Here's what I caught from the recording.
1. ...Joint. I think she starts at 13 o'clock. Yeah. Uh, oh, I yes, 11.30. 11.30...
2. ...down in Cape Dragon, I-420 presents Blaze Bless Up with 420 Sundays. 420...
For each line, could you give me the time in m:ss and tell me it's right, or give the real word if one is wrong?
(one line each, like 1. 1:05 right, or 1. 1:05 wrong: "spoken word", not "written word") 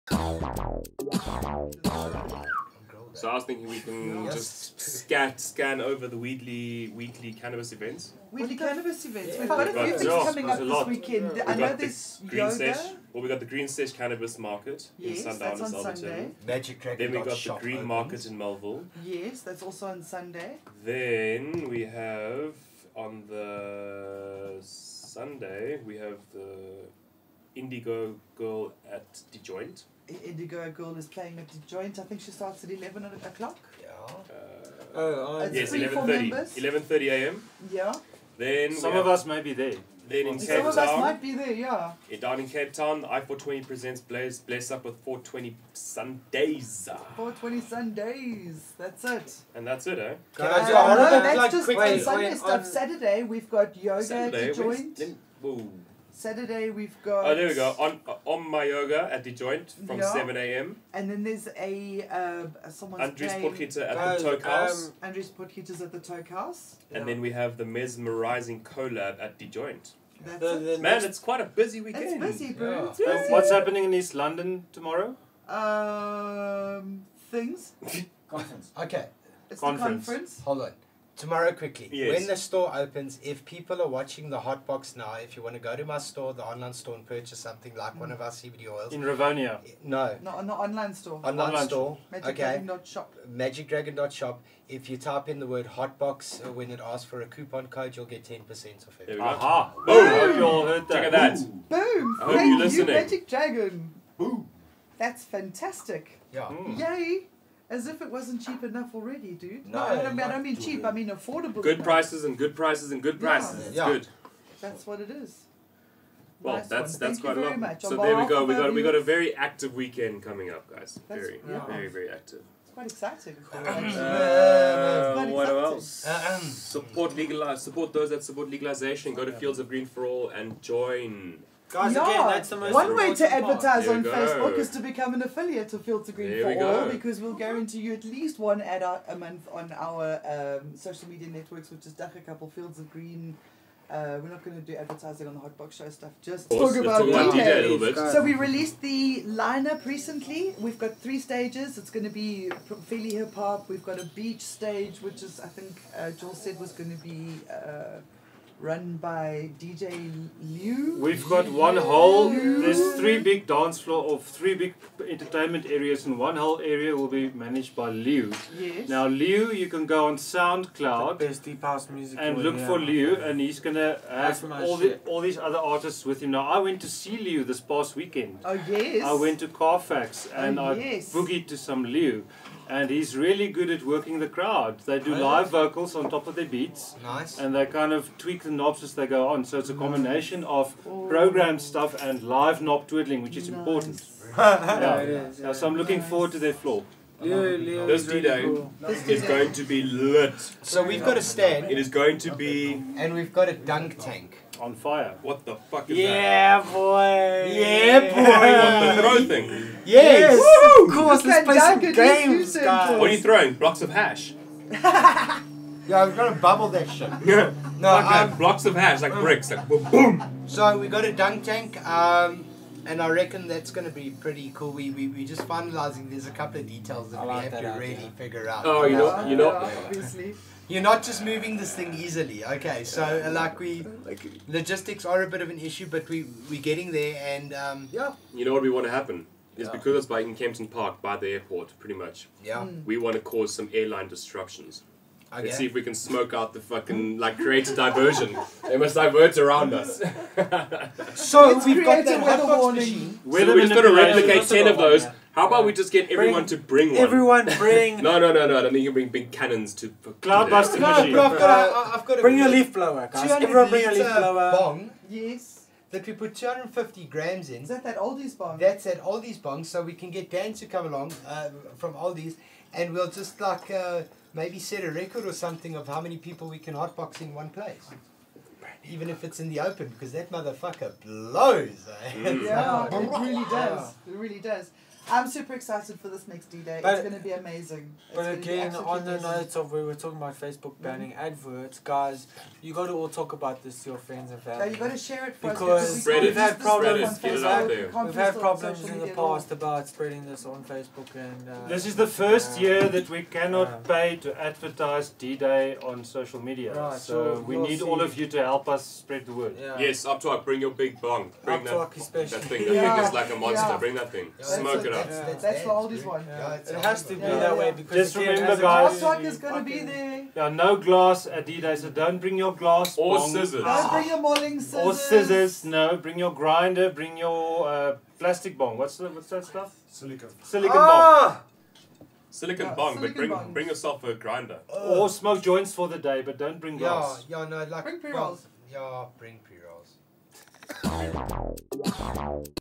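1. 0:31 wrong: "11", not "13"
2. 0:42 wrong: "Town", not "Dragon".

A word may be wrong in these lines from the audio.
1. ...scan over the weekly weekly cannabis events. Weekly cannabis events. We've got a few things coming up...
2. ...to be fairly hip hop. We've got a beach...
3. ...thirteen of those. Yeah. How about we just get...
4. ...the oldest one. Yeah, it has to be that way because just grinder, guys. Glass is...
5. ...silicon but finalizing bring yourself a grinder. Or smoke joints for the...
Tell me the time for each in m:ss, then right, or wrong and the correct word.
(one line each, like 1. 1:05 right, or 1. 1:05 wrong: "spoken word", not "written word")
1. 0:05 right
2. 2:32 right
3. 4:14 wrong: "ten", not "thirteen"
4. 5:15 wrong: "remember", not "grinder"
5. 5:32 wrong: "bring", not "finalizing".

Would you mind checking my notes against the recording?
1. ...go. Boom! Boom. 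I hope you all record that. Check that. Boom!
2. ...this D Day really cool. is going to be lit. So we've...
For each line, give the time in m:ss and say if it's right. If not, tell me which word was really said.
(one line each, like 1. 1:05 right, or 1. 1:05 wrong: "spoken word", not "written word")
1. 1:39 wrong: "heard", not "record"
2. 3:17 right.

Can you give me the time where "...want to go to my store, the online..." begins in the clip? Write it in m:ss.
1:25.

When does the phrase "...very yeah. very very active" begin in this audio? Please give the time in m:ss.
2:01.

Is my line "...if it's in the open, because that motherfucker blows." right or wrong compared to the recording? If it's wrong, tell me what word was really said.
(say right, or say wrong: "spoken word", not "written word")
right.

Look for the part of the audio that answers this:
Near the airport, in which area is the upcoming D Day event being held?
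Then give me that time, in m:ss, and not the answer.
4:00.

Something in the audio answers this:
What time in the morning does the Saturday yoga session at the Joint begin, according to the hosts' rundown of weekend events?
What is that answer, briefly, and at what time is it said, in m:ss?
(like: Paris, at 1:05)
7 a.m., at 1:00.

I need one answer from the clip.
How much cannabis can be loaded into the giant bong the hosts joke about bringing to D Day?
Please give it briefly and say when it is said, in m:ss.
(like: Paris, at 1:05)
250 grams, at 4:26.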